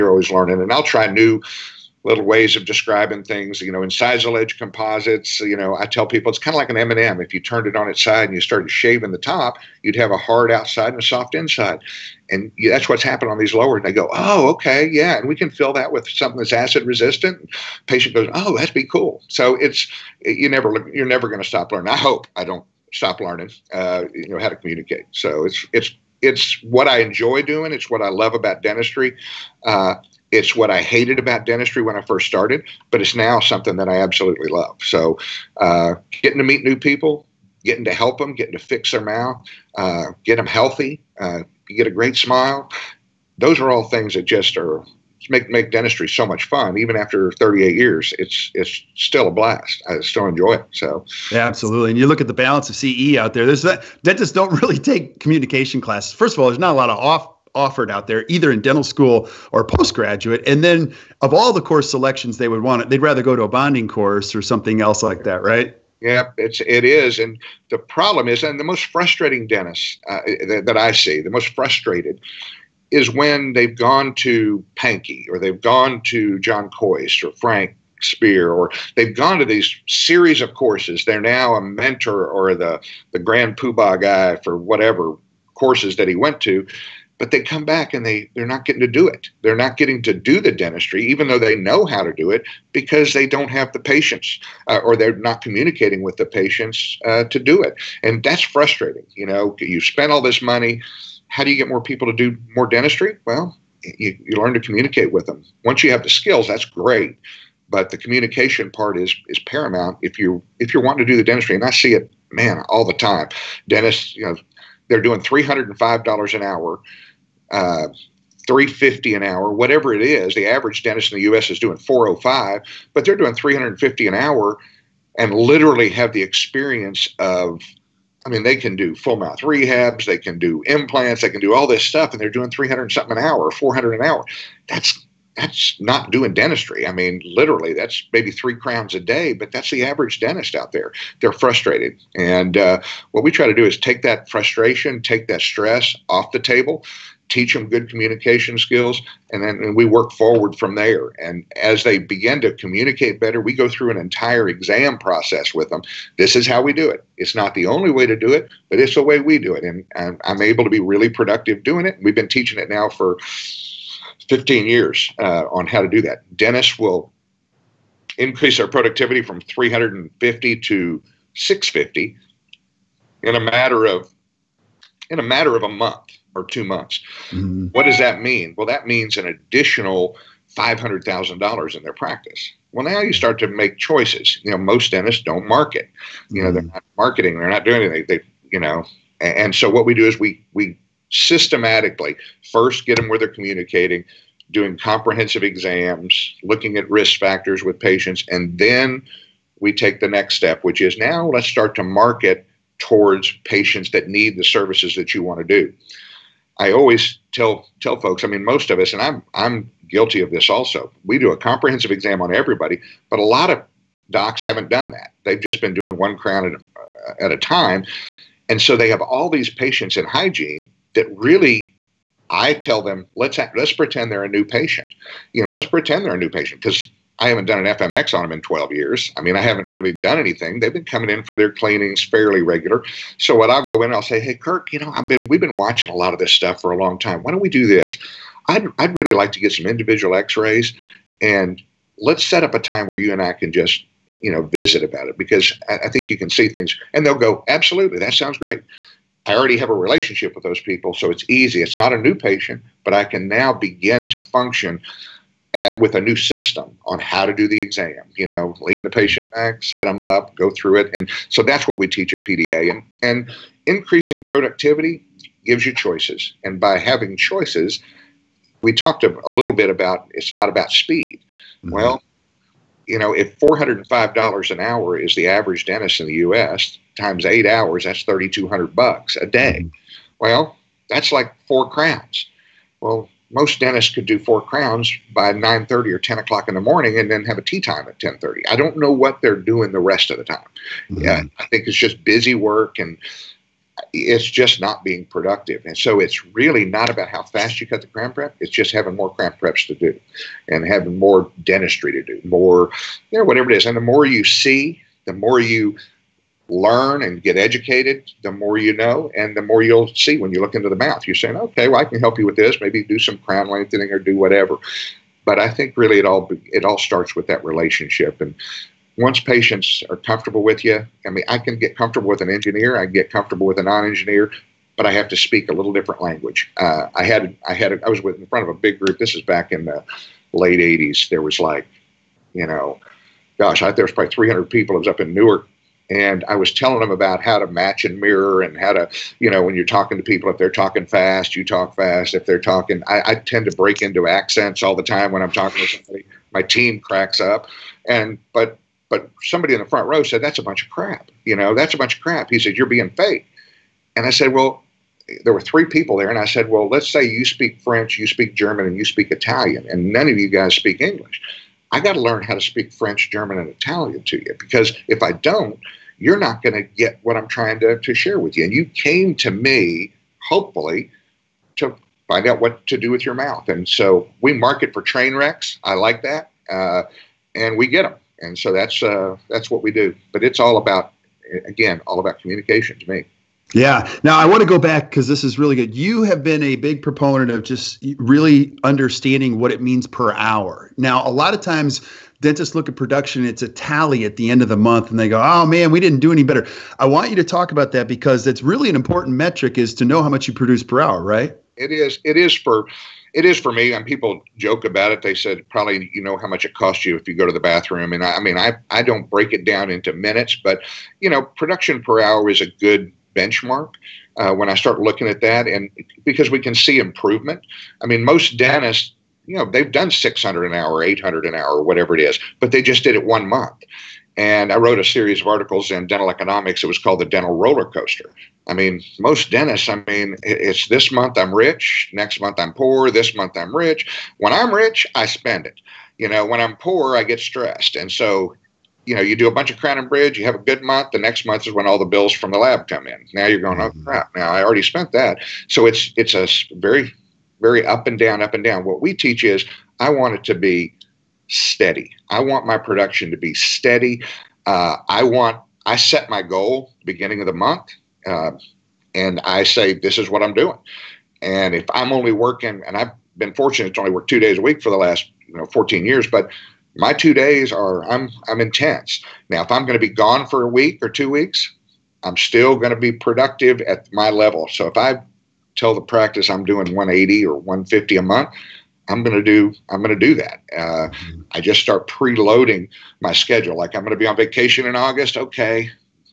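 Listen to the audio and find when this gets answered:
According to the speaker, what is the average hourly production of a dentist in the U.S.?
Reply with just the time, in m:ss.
2:01.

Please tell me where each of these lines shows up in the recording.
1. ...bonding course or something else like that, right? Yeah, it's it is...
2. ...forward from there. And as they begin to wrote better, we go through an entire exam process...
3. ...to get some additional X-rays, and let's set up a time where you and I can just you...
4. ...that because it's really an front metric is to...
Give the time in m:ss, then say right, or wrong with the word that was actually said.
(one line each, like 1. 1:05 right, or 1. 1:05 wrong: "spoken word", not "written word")
1. 1:03 right
2. 2:30 wrong: "communicate", not "wrote"
3. 3:59 wrong: "individual", not "additional"
4. 6:37 wrong: "important", not "front".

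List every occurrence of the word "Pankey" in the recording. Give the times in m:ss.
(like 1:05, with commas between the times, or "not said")
1:14.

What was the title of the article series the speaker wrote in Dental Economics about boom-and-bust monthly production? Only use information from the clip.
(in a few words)
The dental roller coaster.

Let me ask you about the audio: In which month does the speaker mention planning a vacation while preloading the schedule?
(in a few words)
August.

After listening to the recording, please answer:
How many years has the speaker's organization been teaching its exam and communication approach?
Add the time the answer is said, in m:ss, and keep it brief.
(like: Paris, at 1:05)
15 years, at 2:44.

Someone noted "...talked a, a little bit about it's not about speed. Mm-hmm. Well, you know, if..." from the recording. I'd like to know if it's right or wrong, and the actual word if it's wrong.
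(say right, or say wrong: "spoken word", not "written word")
right.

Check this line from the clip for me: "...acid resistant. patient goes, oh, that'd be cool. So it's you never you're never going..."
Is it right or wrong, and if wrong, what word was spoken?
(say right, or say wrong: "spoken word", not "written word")
right.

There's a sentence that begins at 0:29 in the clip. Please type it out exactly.
Uh, it's what I hated about dentistry when I first started, but it's now something that I absolutely love.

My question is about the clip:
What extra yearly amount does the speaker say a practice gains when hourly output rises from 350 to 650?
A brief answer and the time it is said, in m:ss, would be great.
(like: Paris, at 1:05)
$500,000, at 3:00.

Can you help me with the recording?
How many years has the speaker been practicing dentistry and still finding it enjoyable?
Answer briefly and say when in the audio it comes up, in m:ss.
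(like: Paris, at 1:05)
38 years, at 0:47.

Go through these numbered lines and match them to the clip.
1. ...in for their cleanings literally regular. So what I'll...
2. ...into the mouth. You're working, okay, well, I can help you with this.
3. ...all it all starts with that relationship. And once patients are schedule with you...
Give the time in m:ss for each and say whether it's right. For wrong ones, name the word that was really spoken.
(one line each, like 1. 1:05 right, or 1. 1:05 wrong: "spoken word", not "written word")
1. 3:51 wrong: "fairly", not "literally"
2. 5:10 wrong: "saying", not "working"
3. 5:16 wrong: "comfortable", not "schedule".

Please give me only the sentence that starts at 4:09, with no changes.
I already have a relationship with those people, so it's easy.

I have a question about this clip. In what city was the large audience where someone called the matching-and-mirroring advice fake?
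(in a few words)
Newark.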